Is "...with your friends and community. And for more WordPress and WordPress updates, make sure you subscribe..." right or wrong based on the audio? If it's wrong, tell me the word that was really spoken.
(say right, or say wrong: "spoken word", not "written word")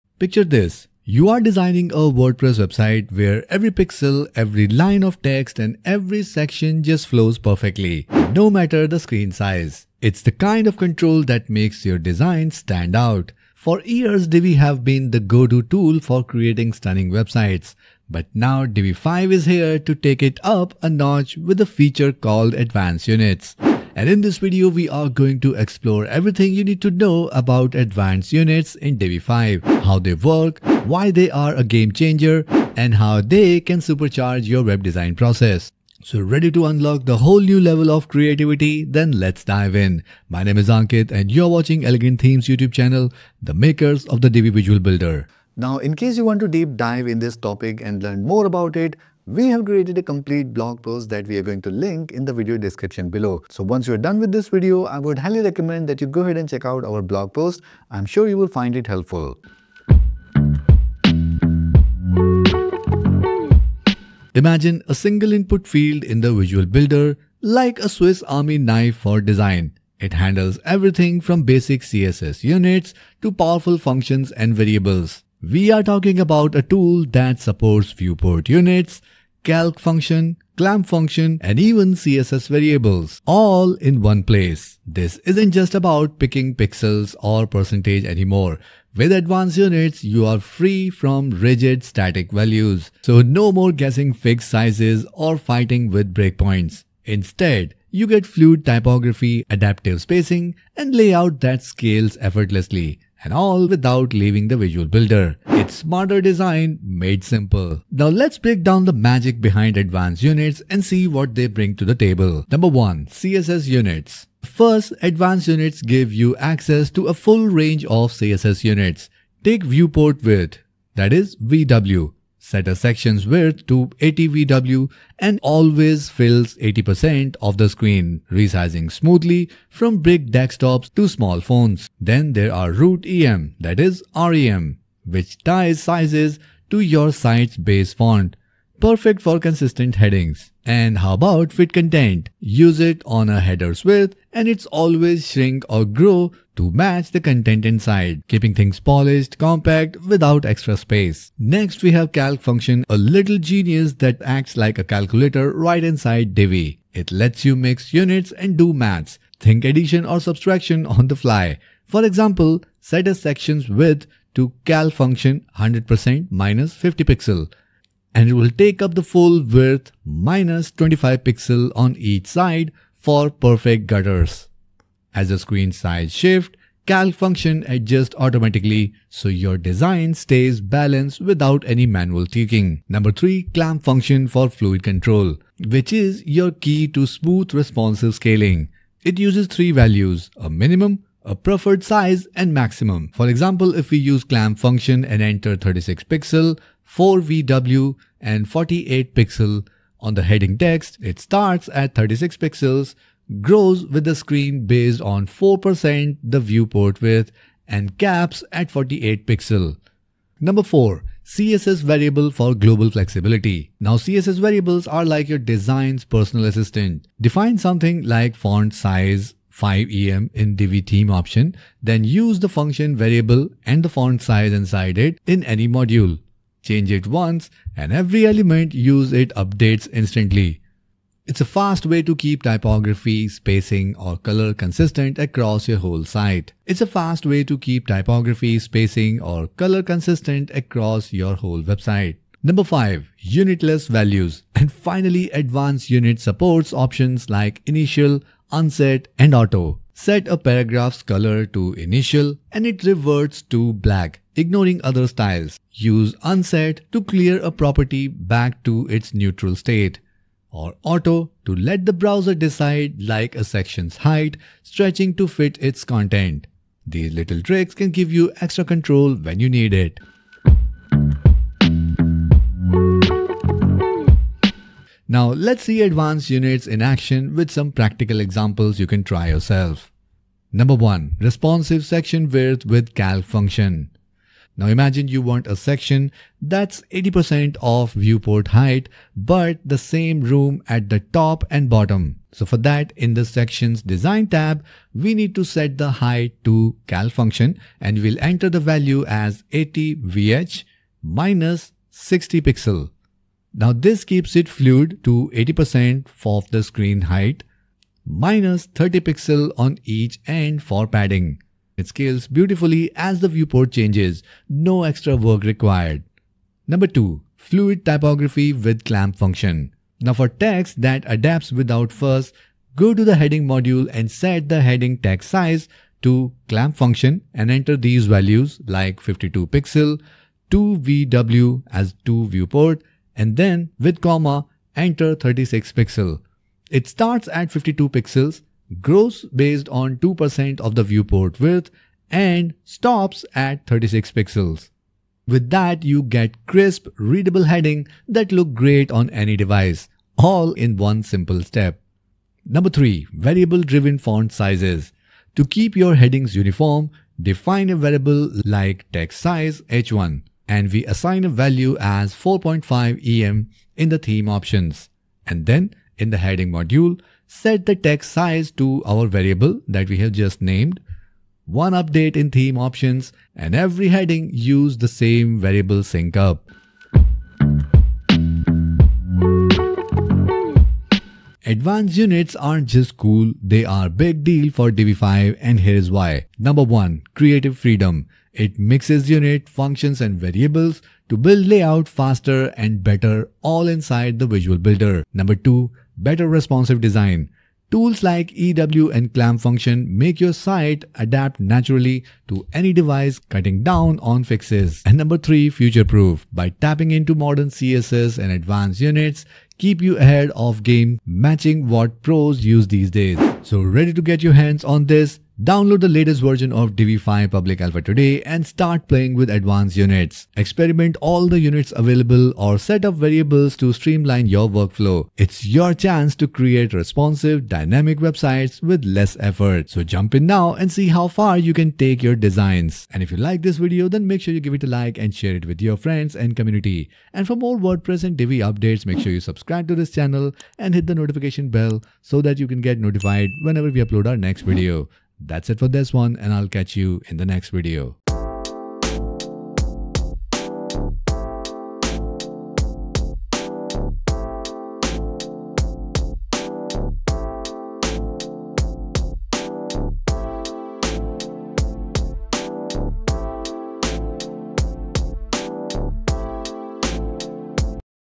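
wrong: "Divi", not "WordPress".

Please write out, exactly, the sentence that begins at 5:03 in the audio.
Now this keeps it fluid to 80% of the screen height minus 30 pixel on each end for padding.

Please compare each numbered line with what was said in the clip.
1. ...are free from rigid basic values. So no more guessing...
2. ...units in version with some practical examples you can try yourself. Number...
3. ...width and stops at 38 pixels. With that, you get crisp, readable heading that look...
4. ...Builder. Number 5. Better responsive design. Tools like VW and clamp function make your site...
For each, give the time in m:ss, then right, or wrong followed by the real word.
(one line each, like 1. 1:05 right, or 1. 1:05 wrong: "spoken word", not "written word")
1. 1:30 wrong: "static", not "basic"
2. 4:36 wrong: "action", not "version"
3. 5:41 wrong: "36", not "38"
4. 6:34 wrong: "2", not "5".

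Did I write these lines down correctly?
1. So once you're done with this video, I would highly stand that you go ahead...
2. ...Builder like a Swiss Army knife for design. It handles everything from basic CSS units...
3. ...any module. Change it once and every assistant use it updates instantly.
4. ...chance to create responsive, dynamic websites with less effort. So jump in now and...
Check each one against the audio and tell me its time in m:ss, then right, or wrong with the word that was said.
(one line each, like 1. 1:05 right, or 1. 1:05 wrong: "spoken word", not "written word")
1. 0:53 wrong: "recommend", not "stand"
2. 1:06 right
3. 3:45 wrong: "element", not "assistant"
4. 7:05 right.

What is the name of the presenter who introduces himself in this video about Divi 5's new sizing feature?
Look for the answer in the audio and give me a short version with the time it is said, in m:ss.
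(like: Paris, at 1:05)
Ankit, at 0:40.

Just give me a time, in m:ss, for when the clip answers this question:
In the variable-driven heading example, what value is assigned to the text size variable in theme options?
6:02.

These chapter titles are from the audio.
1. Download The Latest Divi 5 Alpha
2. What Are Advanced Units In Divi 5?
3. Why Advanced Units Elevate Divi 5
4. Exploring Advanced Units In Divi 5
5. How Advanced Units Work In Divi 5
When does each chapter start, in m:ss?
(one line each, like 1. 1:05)
1. 6:48
2. 1:00
3. 6:11
4. 1:46
5. 4:25.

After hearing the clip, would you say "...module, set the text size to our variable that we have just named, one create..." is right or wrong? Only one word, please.
wrong.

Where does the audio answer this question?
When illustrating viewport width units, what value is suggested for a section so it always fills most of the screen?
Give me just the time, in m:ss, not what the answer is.
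2:03.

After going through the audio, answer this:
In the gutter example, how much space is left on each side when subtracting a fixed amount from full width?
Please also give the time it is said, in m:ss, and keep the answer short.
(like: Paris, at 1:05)
25 pixels, at 2:50.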